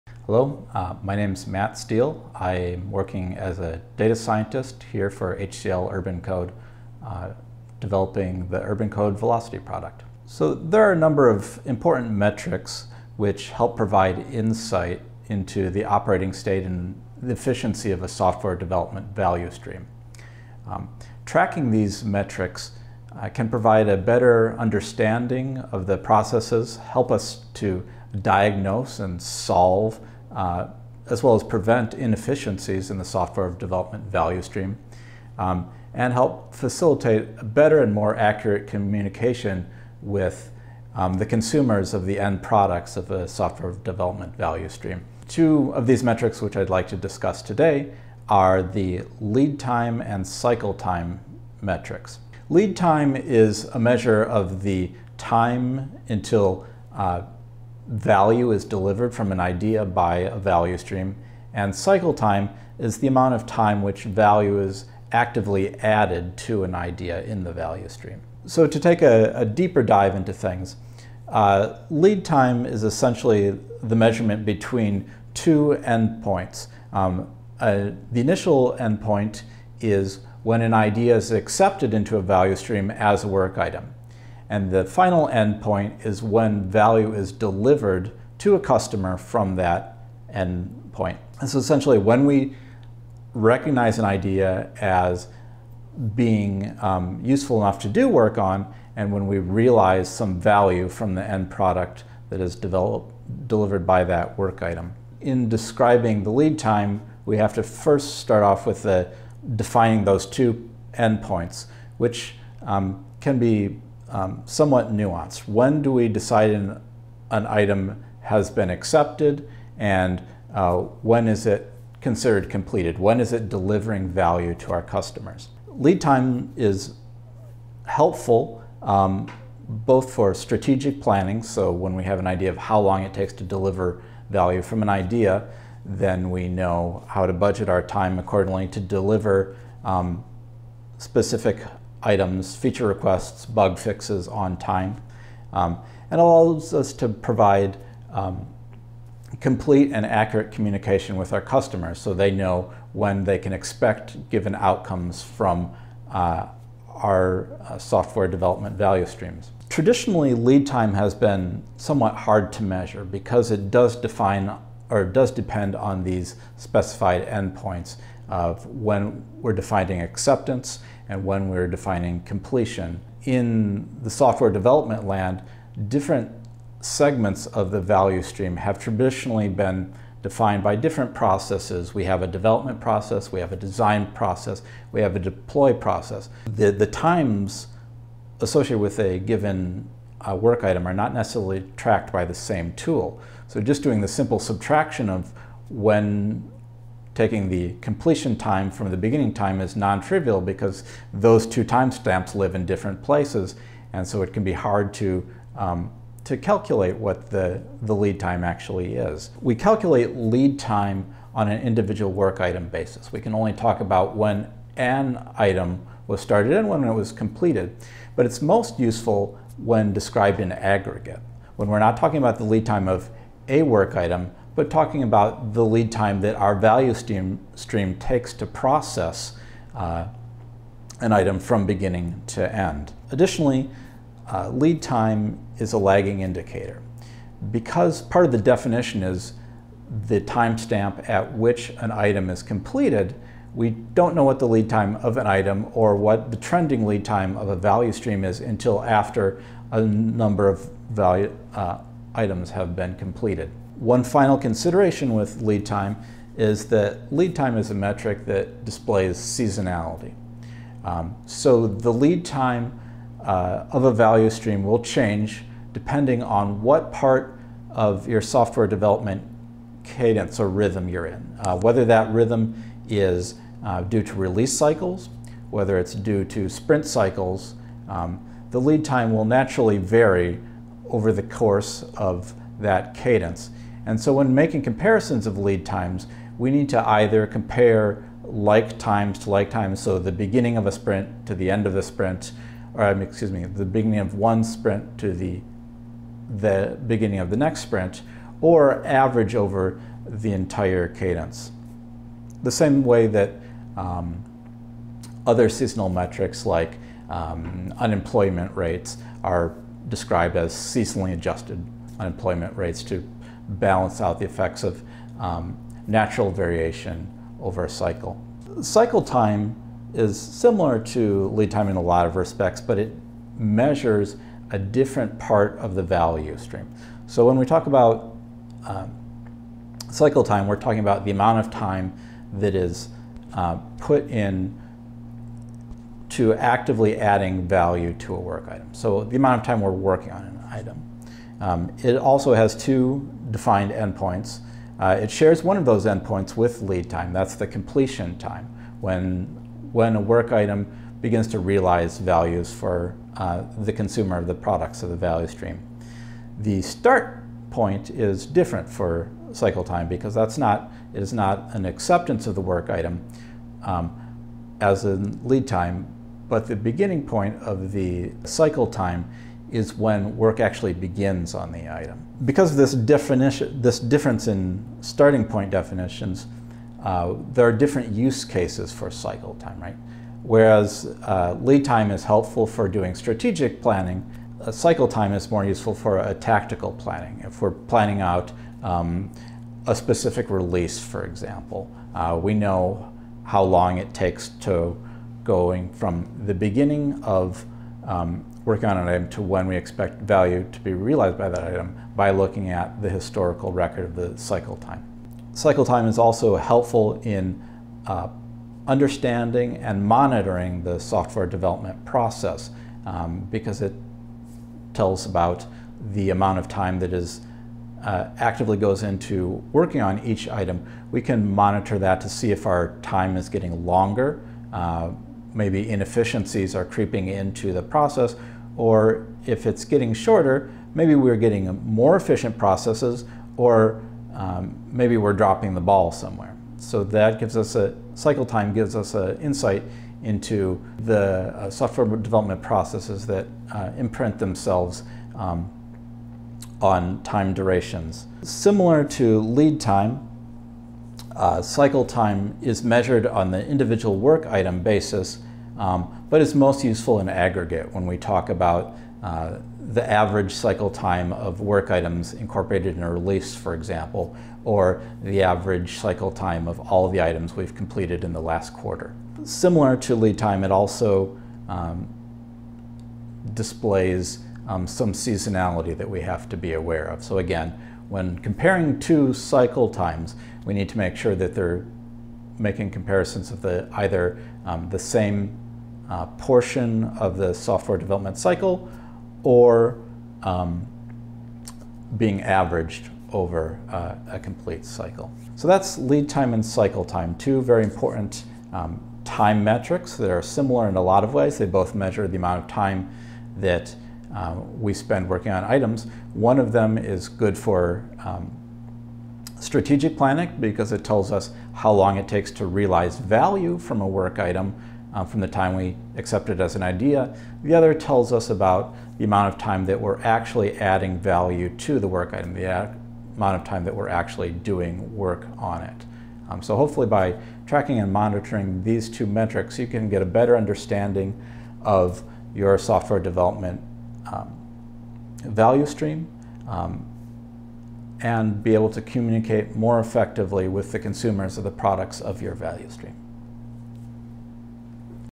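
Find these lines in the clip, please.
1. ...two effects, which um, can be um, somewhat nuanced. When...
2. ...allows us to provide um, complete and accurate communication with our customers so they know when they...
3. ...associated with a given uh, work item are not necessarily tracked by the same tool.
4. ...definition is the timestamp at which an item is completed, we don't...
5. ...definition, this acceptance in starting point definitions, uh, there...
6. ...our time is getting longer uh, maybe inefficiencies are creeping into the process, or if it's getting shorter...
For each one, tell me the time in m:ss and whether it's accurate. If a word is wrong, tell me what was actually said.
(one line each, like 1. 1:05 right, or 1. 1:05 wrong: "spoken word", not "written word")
1. 1:50 wrong: "endpoints", not "effects"
2. 2:26 right
3. 3:08 right
4. 3:58 right
5. 6:12 wrong: "difference", not "acceptance"
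6. 7:02 right.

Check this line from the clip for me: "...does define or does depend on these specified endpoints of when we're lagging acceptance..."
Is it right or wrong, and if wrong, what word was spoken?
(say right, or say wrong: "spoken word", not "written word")
wrong: "defining", not "lagging".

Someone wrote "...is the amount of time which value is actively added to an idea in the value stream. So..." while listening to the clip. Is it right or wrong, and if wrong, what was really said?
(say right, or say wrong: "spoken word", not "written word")
right.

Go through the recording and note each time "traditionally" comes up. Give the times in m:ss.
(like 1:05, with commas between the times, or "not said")
2:39, 2:58.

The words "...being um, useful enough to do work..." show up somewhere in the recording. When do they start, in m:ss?
1:36.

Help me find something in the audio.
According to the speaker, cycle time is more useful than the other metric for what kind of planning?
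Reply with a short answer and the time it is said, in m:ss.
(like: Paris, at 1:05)
Tactical planning, at 6:26.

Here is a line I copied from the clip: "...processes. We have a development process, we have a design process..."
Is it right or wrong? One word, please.
right.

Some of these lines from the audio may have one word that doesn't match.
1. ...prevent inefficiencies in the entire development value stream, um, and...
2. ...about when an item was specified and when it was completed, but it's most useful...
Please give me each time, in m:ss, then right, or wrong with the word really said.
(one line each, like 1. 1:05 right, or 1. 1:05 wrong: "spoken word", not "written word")
1. 0:31 wrong: "software", not "entire"
2. 3:33 wrong: "started", not "specified".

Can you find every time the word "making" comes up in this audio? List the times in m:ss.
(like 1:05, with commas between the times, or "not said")
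4:44, 8:02.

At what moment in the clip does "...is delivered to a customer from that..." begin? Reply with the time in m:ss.
1:27.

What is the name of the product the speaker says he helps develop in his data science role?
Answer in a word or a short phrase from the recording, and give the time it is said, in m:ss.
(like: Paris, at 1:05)
UrbanCode Velocity, at 0:08.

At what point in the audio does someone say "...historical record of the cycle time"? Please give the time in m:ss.
6:42.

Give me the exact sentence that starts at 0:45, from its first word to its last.
Two of these metrics which I'd like to discuss today are the lead time and cycle time metrics.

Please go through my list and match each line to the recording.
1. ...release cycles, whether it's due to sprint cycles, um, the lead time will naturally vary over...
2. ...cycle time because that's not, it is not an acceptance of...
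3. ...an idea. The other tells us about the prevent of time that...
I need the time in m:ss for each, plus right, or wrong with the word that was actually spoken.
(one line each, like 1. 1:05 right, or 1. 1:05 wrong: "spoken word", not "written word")
1. 4:34 right
2. 5:59 right
3. 8:36 wrong: "amount", not "prevent".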